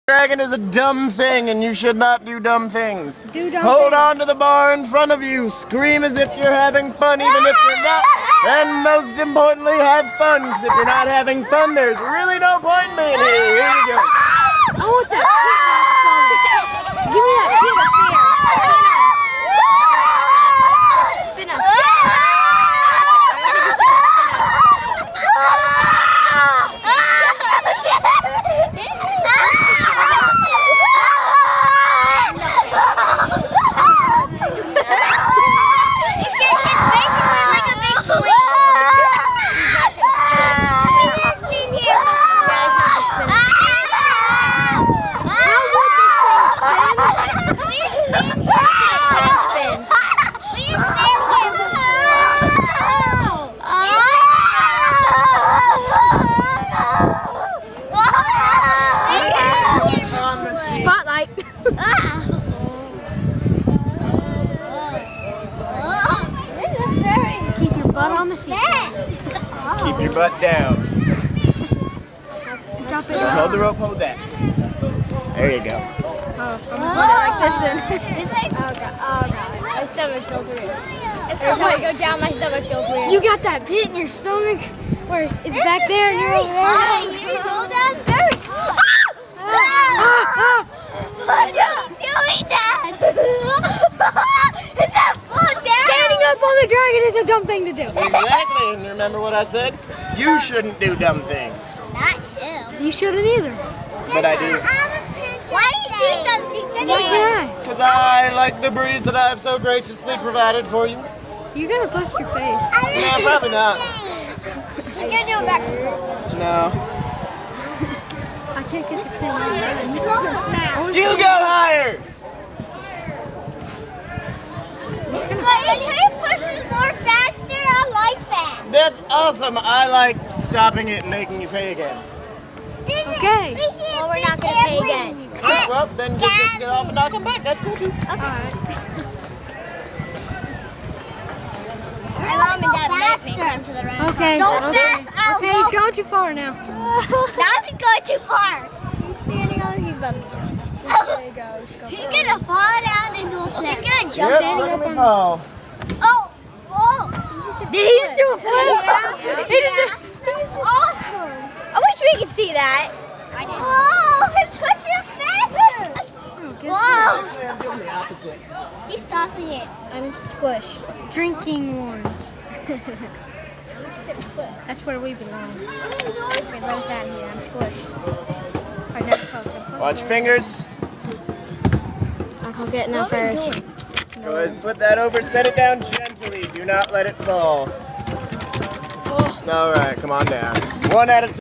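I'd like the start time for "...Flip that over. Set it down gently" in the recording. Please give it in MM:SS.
03:04.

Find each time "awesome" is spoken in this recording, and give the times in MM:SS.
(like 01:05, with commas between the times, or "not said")
02:09, 02:40.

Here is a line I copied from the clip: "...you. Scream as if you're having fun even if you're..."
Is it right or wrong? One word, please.
right.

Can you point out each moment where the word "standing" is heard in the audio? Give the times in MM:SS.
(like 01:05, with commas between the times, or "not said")
02:29, 02:34.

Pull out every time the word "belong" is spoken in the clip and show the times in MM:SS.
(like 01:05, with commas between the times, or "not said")
02:55.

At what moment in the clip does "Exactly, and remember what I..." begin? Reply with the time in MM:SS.
01:37.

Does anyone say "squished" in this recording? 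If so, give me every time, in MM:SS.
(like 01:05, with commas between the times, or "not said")
02:50, 02:57.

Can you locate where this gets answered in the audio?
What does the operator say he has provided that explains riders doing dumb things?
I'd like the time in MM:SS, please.
01:48.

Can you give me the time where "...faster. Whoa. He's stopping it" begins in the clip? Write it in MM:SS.
02:48.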